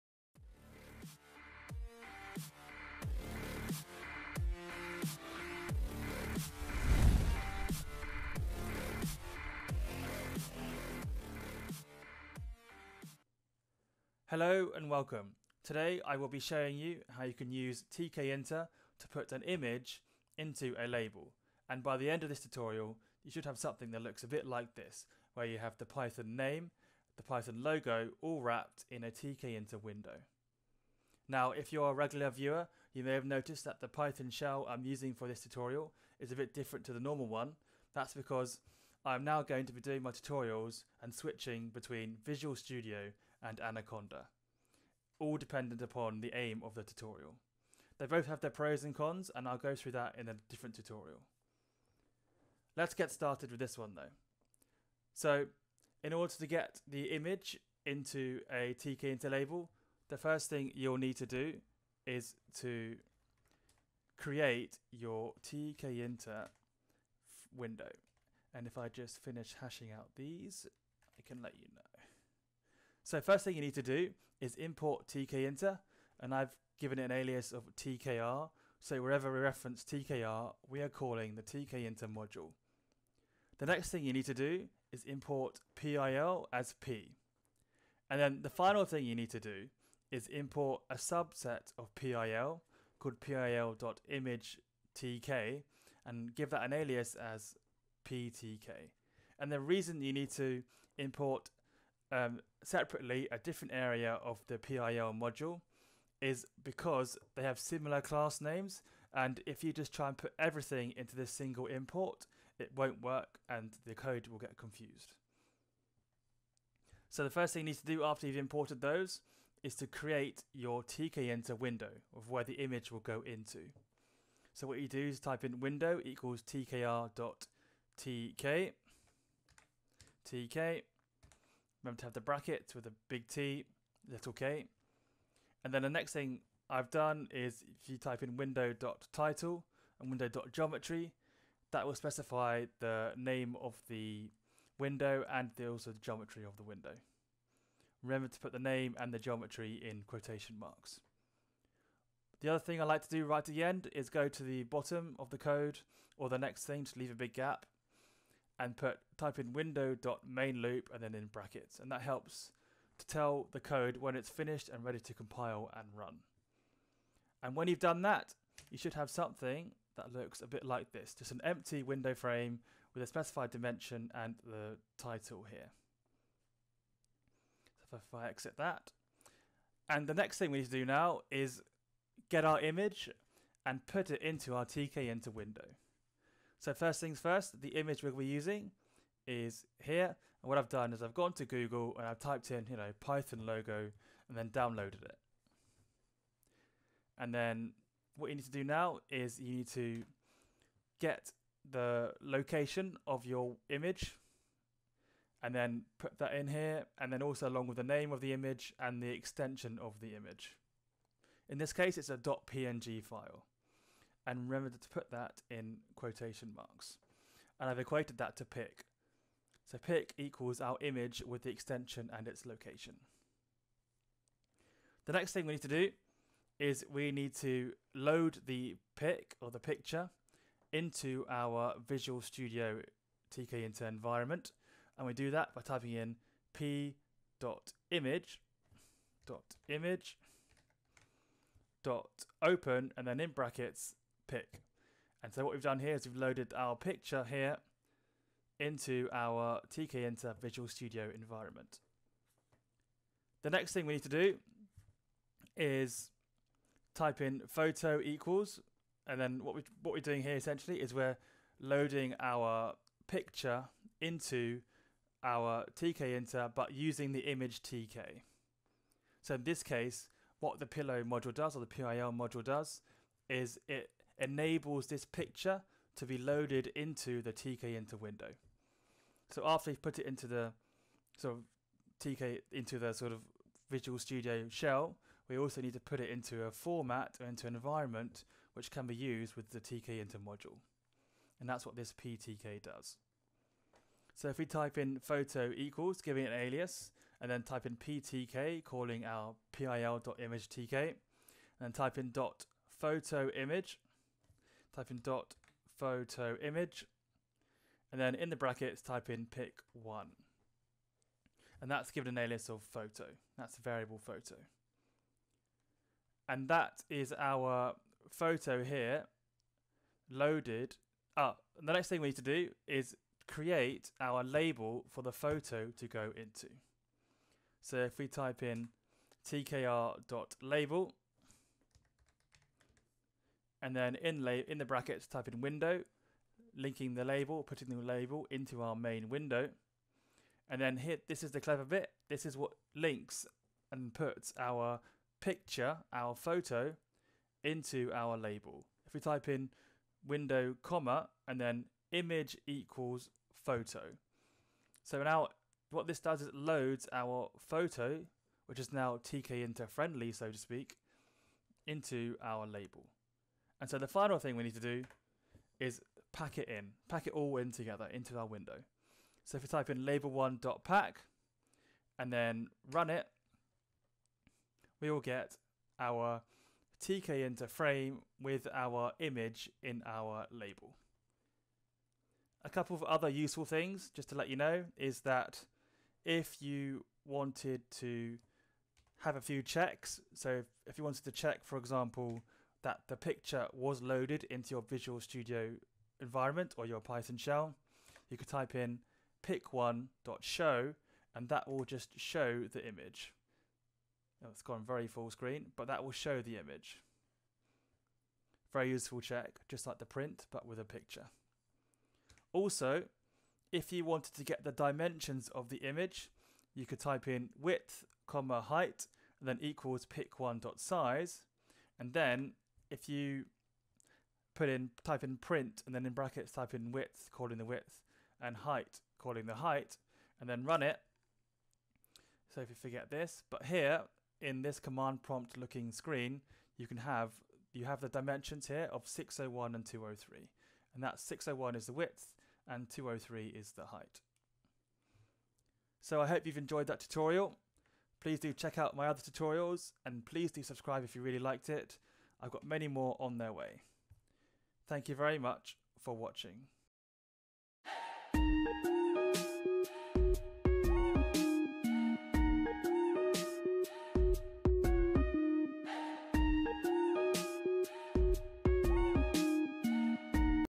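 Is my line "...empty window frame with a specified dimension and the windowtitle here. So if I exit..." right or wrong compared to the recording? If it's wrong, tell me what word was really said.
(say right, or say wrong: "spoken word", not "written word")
wrong: "title", not "windowtitle".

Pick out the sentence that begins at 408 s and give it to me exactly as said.
Very useful check, just like the print, but with a picture.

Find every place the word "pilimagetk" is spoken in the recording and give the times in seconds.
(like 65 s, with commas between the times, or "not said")
93 s, 299 s.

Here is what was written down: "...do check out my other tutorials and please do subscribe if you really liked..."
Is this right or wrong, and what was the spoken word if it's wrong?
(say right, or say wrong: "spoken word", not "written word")
right.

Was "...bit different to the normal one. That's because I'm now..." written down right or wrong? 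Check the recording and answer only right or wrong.
right.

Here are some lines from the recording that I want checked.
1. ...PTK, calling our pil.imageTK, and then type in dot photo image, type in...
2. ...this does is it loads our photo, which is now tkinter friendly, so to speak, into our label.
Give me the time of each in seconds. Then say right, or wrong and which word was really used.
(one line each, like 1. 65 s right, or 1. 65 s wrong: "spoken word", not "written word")
1. 297 s right
2. 355 s right.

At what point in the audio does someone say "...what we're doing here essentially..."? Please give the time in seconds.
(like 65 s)
259 s.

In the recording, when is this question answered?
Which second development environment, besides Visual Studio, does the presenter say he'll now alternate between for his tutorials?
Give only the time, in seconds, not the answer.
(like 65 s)
43 s.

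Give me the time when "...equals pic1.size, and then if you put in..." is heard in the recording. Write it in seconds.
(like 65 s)
419 s.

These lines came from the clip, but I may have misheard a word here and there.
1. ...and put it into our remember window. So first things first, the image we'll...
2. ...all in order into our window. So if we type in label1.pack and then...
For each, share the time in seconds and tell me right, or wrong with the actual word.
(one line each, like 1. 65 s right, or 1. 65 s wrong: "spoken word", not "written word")
1. 183 s wrong: "tkinter", not "remember"
2. 367 s wrong: "together", not "order".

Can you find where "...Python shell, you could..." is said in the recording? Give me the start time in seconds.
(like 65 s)
396 s.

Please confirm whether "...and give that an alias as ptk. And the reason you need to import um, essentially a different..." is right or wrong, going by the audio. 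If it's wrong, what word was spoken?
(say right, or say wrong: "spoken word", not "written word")
wrong: "separately", not "essentially".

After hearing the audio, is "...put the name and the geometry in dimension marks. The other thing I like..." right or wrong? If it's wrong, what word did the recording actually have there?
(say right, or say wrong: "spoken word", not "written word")
wrong: "quotation", not "dimension".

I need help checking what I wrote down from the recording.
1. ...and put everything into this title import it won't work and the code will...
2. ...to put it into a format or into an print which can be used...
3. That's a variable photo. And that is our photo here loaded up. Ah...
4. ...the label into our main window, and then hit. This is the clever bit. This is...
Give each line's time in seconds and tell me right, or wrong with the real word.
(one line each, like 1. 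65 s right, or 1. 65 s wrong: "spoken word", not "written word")
1. 110 s wrong: "single", not "title"
2. 285 s wrong: "environment", not "print"
3. 313 s right
4. 337 s right.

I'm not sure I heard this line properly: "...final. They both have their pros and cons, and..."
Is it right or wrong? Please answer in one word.
wrong.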